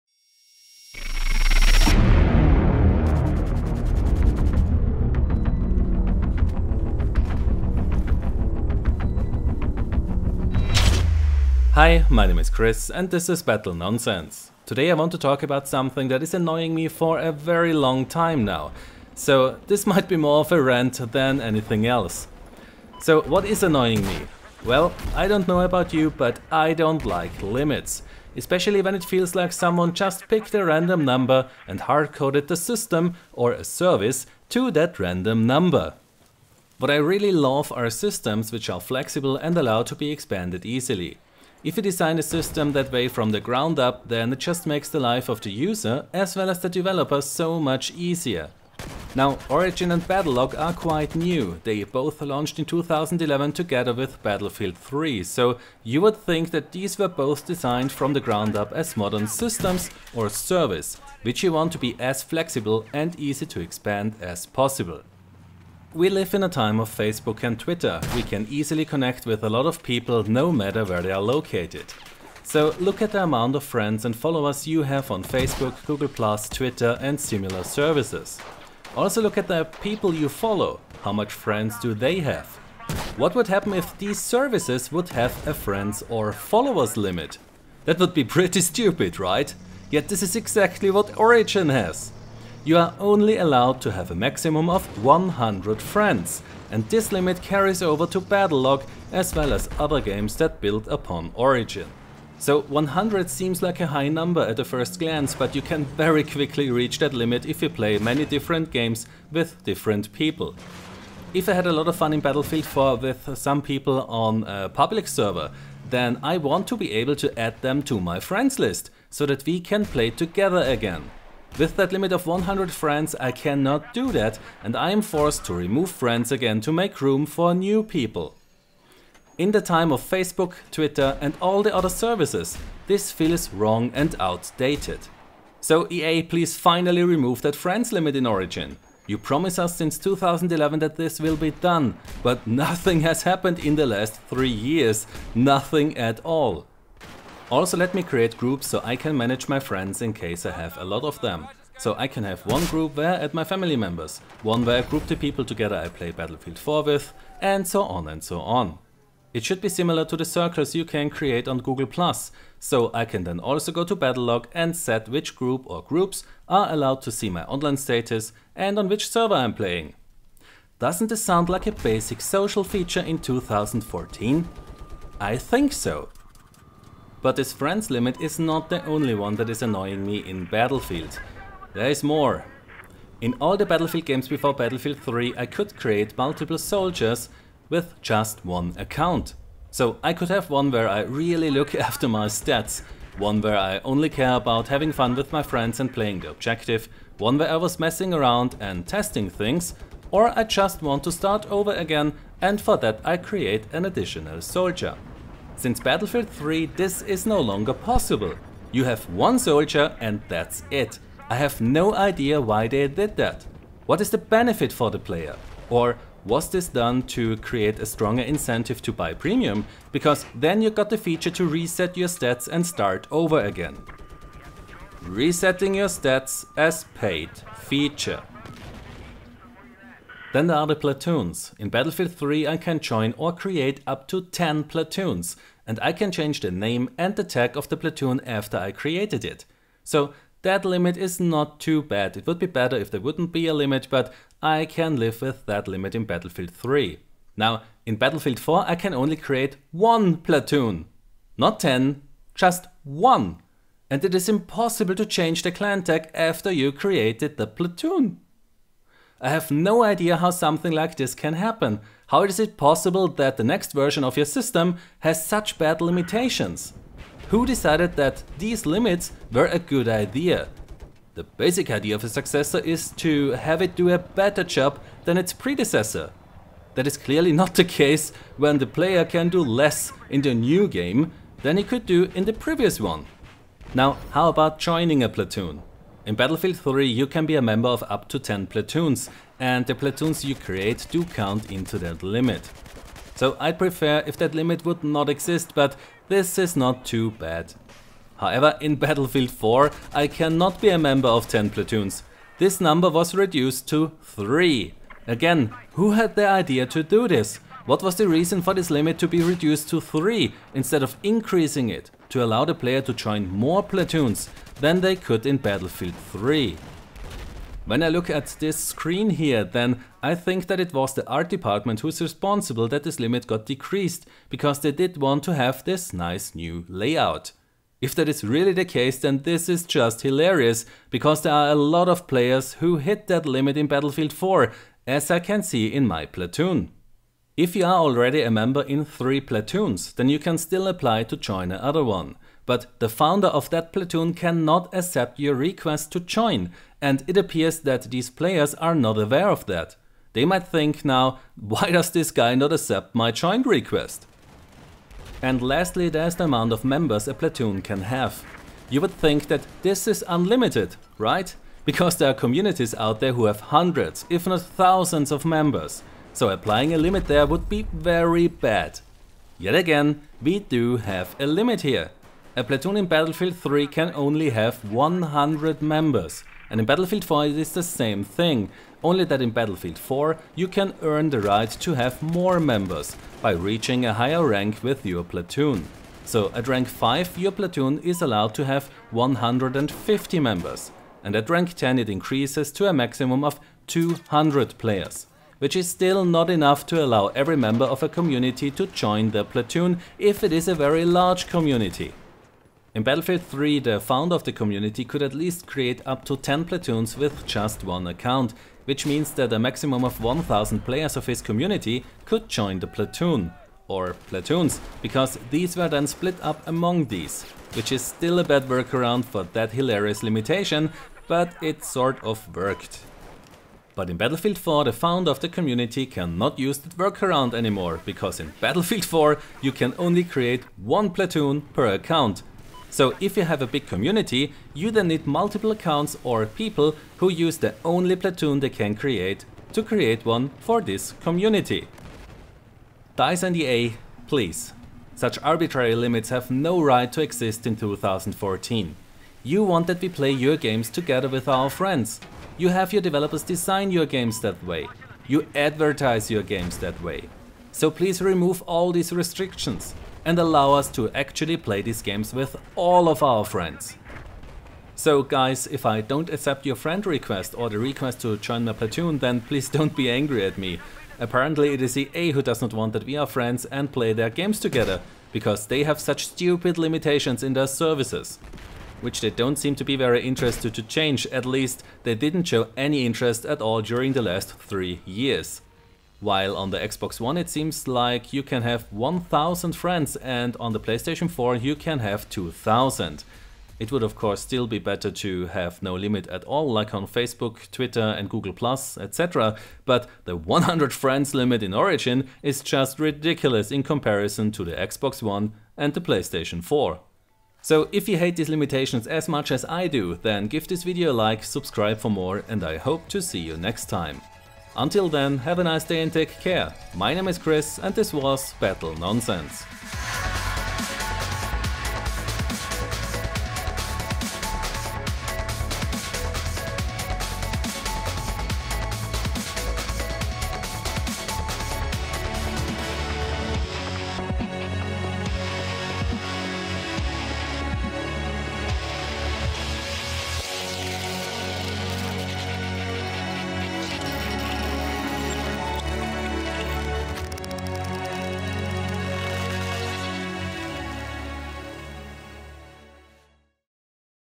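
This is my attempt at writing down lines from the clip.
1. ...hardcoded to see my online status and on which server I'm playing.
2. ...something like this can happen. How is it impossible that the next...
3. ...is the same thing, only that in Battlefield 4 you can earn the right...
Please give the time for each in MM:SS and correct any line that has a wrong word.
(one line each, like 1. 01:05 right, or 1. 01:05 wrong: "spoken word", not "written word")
1. 02:46 wrong: "allowed", not "hardcoded"
2. 04:20 wrong: "possible", not "impossible"
3. 06:17 right.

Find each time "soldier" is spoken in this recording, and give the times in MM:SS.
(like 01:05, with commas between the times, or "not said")
03:06, 03:24, 03:29.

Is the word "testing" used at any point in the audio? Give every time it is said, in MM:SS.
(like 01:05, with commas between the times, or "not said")
03:18.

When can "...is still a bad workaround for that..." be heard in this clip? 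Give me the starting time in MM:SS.
06:57.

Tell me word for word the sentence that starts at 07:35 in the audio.
You advertise your games that way.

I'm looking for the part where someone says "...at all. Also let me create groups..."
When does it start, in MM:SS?
02:25.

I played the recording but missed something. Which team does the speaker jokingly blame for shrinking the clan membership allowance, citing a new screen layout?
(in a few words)
the art department.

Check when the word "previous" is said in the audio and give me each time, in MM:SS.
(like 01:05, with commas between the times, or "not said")
04:42.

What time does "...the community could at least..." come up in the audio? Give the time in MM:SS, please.
06:44.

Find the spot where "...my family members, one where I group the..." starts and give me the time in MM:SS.
02:33.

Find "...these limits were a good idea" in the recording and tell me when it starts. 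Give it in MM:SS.
04:28.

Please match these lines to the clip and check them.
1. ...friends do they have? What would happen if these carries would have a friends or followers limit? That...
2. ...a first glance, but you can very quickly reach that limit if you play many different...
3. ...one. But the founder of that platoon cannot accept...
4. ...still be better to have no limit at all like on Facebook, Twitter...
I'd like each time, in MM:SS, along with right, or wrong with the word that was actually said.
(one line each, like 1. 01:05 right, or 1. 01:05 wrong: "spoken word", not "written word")
1. 01:21 wrong: "services", not "carries"
2. 01:44 right
3. 05:41 right
4. 08:14 right.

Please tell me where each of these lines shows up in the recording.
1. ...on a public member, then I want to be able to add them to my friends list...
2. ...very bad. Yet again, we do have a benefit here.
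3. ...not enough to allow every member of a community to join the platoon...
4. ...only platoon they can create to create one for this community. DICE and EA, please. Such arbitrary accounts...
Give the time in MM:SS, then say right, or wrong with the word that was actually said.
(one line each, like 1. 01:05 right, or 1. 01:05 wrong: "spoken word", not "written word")
1. 01:54 wrong: "server", not "member"
2. 06:07 wrong: "limit", not "benefit"
3. 06:36 right
4. 07:17 wrong: "limits", not "accounts".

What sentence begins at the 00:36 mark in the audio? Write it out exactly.
What I really love are systems which are flexible and allow to be expanded easily.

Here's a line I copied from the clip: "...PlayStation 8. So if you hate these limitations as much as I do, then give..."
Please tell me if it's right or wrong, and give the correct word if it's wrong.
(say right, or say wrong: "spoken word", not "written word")
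wrong: "4", not "8".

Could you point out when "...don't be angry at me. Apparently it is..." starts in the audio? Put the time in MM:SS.
07:49.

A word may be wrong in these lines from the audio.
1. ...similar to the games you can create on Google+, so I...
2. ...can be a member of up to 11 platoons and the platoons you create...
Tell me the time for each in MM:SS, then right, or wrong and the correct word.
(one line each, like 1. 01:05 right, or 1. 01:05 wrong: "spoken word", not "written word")
1. 02:39 wrong: "circles", not "games"
2. 04:47 wrong: "10", not "11".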